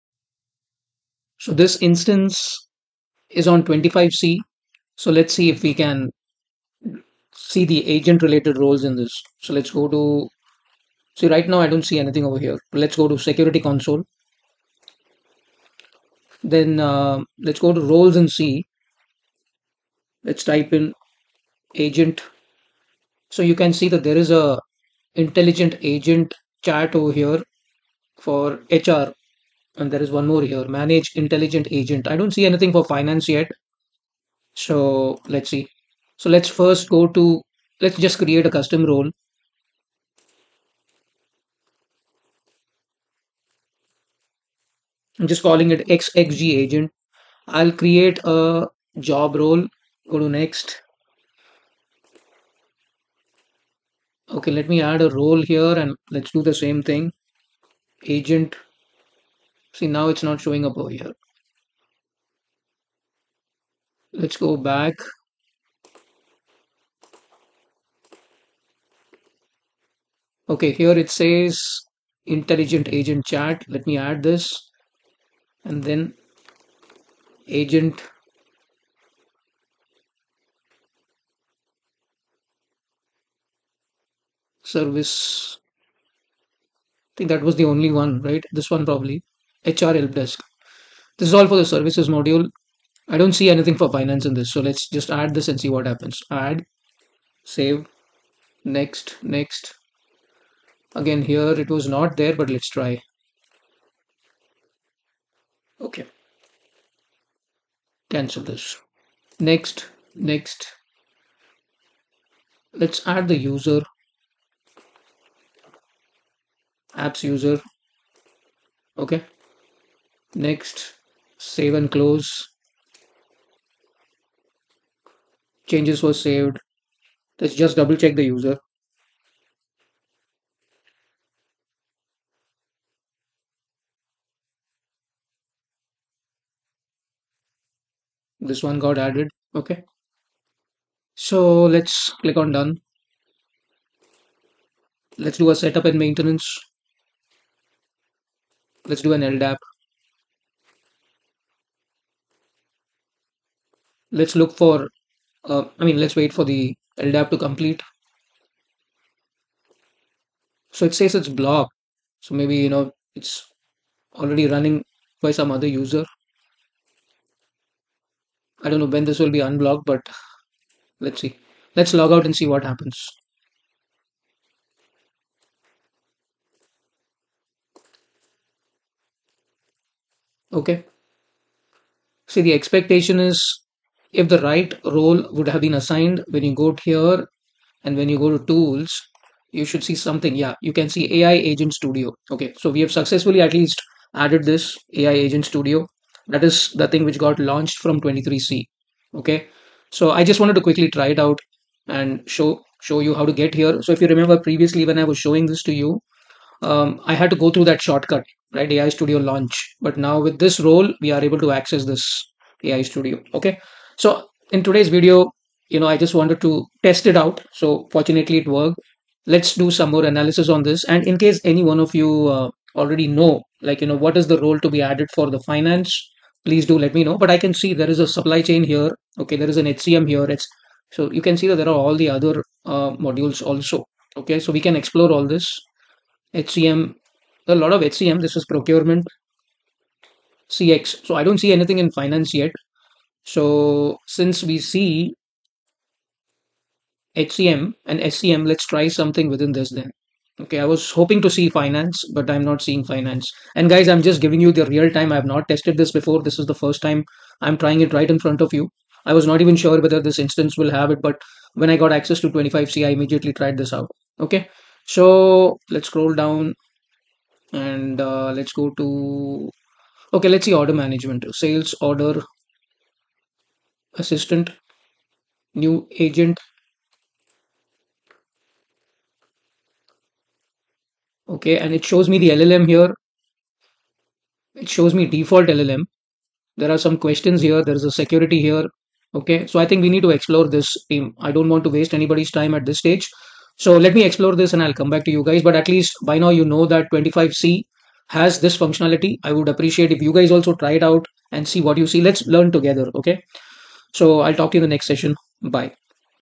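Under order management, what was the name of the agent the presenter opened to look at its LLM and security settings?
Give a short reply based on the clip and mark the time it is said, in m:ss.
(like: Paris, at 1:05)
Sales order assistant, at 4:31.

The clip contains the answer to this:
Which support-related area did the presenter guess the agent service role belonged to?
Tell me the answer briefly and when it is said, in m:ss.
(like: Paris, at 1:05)
HR help desk, at 1:29.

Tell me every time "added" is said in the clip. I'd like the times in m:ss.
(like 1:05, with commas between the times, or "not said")
2:18, 3:14, 3:44.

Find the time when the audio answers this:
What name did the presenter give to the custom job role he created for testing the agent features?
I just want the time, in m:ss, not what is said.
0:45.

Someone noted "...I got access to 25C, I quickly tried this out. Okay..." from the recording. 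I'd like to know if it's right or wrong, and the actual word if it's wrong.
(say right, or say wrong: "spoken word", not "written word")
wrong: "immediately", not "quickly".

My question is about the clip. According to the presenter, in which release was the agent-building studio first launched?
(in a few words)
23C.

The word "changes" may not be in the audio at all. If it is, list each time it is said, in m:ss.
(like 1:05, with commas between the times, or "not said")
2:05.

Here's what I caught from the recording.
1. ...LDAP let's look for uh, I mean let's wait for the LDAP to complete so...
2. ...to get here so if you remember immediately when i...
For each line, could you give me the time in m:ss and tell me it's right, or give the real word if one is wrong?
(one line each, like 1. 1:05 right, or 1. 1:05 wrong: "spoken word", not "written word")
1. 2:29 right
2. 3:23 wrong: "previously", not "immediately".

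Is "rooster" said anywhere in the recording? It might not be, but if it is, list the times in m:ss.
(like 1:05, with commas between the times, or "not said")
not said.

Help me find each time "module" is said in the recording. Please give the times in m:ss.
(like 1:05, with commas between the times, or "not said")
1:32, 3:52.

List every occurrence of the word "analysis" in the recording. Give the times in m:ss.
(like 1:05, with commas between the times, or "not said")
3:40.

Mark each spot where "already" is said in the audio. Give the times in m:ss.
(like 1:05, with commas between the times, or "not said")
2:44, 3:42.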